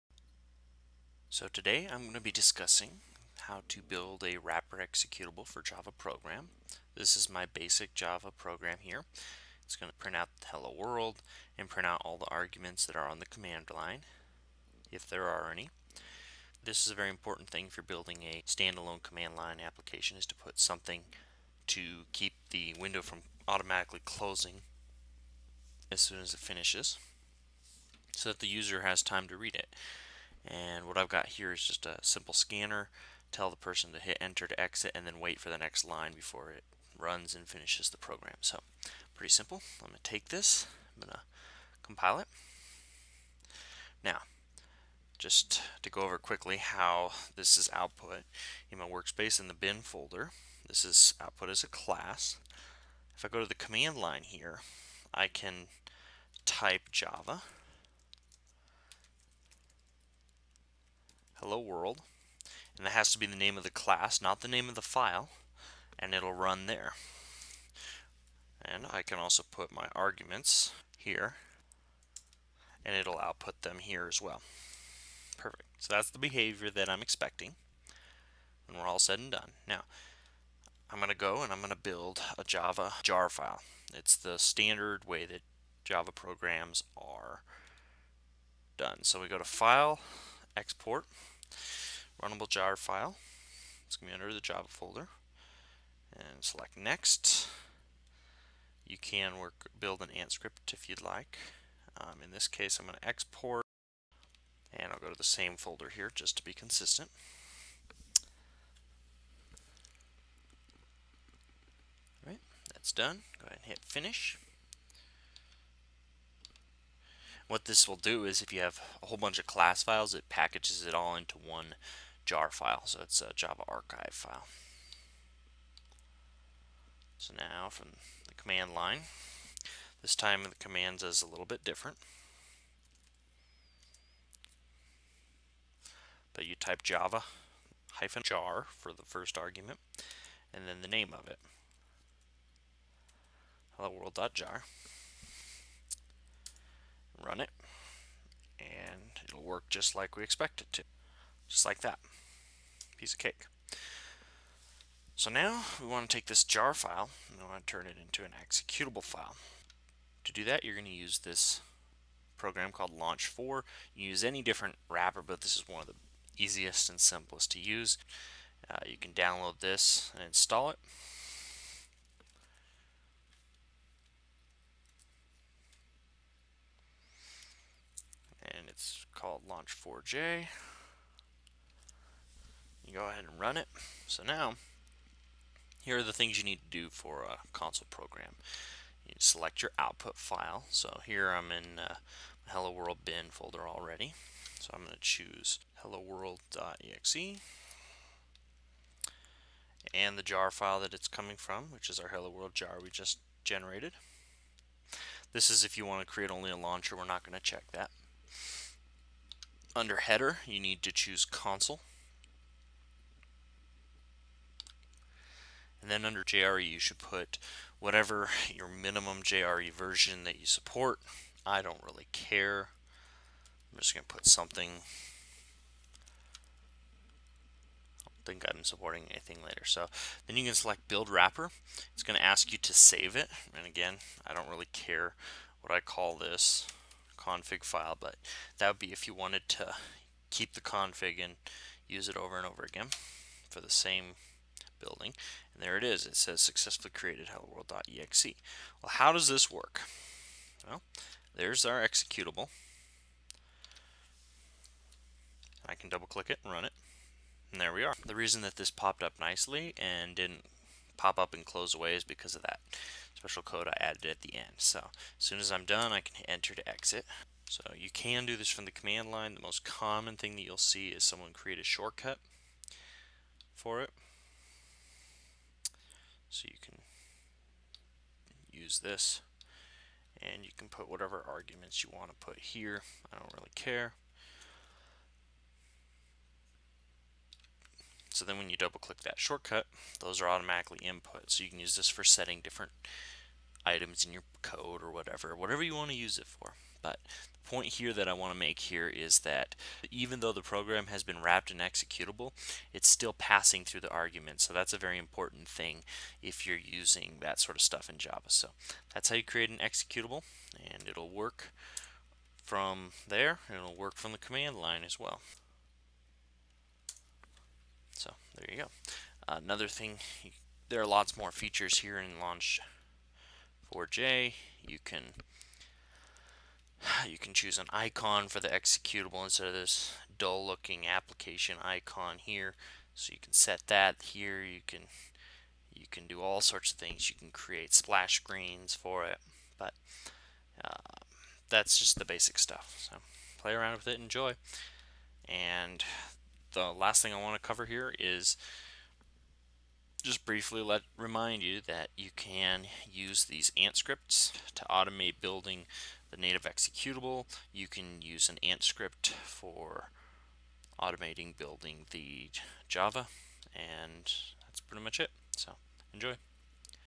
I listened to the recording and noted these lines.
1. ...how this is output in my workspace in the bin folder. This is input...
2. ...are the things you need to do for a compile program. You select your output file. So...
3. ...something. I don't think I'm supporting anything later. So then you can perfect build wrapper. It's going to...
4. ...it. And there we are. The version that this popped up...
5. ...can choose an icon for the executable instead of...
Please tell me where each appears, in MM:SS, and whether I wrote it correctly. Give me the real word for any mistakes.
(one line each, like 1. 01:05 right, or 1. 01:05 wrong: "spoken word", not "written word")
1. 00:46 wrong: "output", not "input"
2. 03:05 wrong: "console", not "compile"
3. 03:44 wrong: "select", not "perfect"
4. 04:16 wrong: "reason", not "version"
5. 05:27 right.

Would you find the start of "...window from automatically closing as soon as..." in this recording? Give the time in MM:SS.
00:22.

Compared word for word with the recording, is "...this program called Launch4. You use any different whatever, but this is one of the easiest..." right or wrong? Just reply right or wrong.
wrong.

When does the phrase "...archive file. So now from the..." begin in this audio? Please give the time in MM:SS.
02:03.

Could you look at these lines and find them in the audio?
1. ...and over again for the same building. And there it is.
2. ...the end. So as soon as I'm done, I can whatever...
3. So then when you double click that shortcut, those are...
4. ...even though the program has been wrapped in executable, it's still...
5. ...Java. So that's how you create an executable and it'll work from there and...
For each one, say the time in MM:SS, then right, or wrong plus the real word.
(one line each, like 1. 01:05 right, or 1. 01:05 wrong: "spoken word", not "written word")
1. 04:02 right
2. 04:24 wrong: "enter", not "whatever"
3. 04:48 right
4. 04:59 right
5. 05:07 right.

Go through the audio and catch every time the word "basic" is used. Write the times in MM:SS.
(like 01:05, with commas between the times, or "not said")
00:07, 05:42.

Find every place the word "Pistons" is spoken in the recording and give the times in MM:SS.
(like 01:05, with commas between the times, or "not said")
not said.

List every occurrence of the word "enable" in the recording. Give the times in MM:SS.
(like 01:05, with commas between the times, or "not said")
not said.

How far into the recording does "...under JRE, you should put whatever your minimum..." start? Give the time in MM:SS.
03:36.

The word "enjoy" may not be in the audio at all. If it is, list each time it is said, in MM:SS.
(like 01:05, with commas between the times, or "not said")
05:43, 06:05.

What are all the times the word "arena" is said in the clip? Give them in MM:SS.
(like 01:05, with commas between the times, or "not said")
not said.